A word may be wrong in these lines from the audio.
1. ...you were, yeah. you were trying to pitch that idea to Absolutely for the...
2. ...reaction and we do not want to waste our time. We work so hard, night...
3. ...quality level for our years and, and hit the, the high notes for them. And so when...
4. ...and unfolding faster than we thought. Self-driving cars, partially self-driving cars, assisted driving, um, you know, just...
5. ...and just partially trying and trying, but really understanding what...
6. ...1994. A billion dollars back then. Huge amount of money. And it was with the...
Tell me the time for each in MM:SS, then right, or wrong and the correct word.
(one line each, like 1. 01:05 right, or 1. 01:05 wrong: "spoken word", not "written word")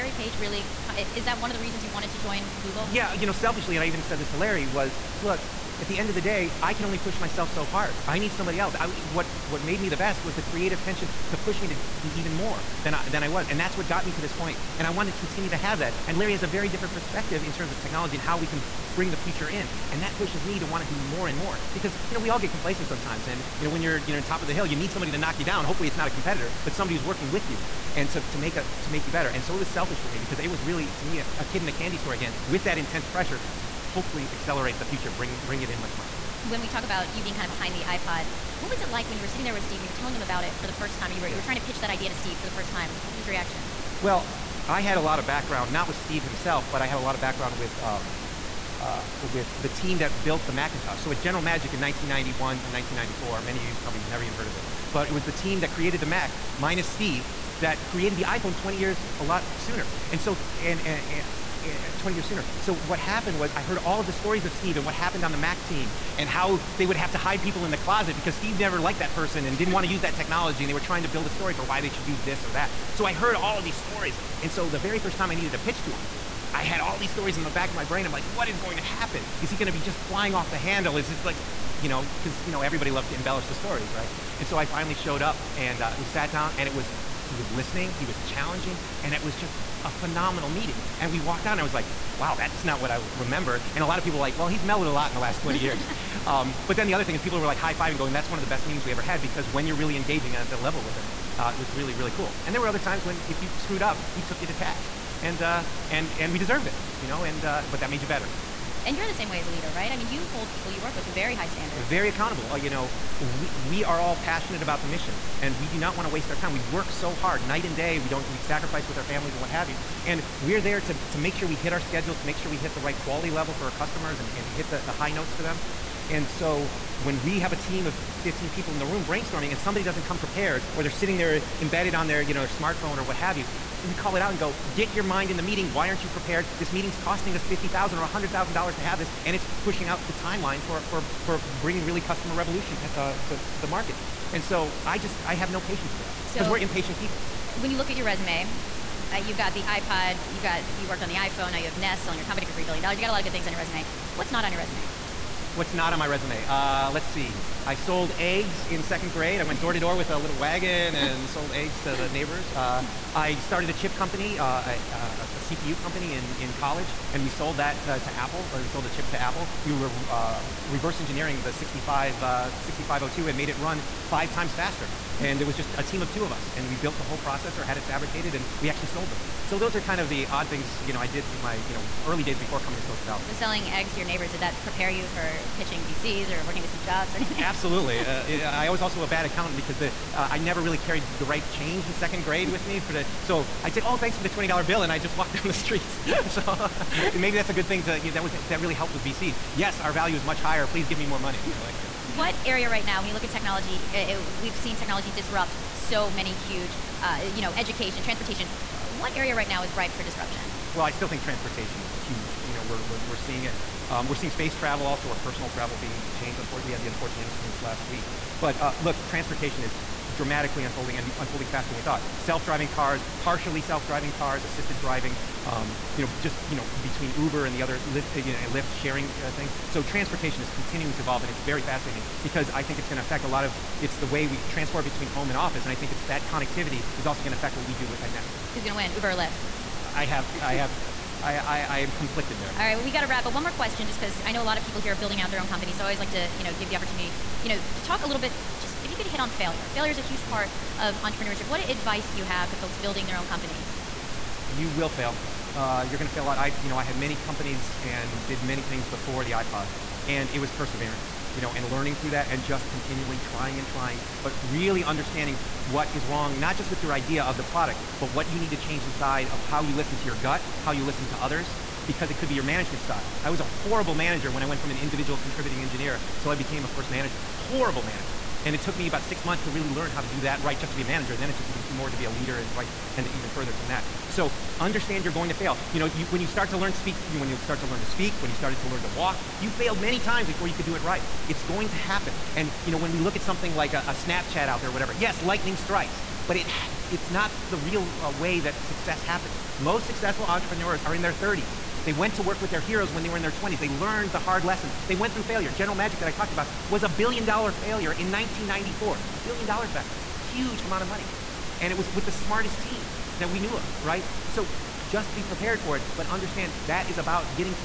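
1. 00:41 wrong: "Steve", not "Absolutely"
2. 01:54 wrong: "mission", not "reaction"
3. 02:02 wrong: "customers", not "years"
4. 03:40 right
5. 04:22 wrong: "continually", not "partially"
6. 05:08 right.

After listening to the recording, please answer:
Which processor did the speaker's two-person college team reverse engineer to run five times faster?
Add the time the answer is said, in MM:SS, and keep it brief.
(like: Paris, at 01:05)
6502, at 02:52.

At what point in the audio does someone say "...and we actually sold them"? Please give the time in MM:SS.
02:58.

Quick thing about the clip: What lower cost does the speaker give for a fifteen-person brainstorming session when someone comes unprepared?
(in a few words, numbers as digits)
$50,000.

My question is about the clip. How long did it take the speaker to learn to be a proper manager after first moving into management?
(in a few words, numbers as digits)
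About six months.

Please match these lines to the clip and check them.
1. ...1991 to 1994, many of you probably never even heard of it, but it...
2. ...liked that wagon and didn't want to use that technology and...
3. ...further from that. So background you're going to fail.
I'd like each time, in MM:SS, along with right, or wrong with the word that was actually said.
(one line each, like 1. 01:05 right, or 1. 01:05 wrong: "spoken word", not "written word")
1. 00:51 right
2. 01:08 wrong: "person", not "wagon"
3. 04:43 wrong: "understand", not "background".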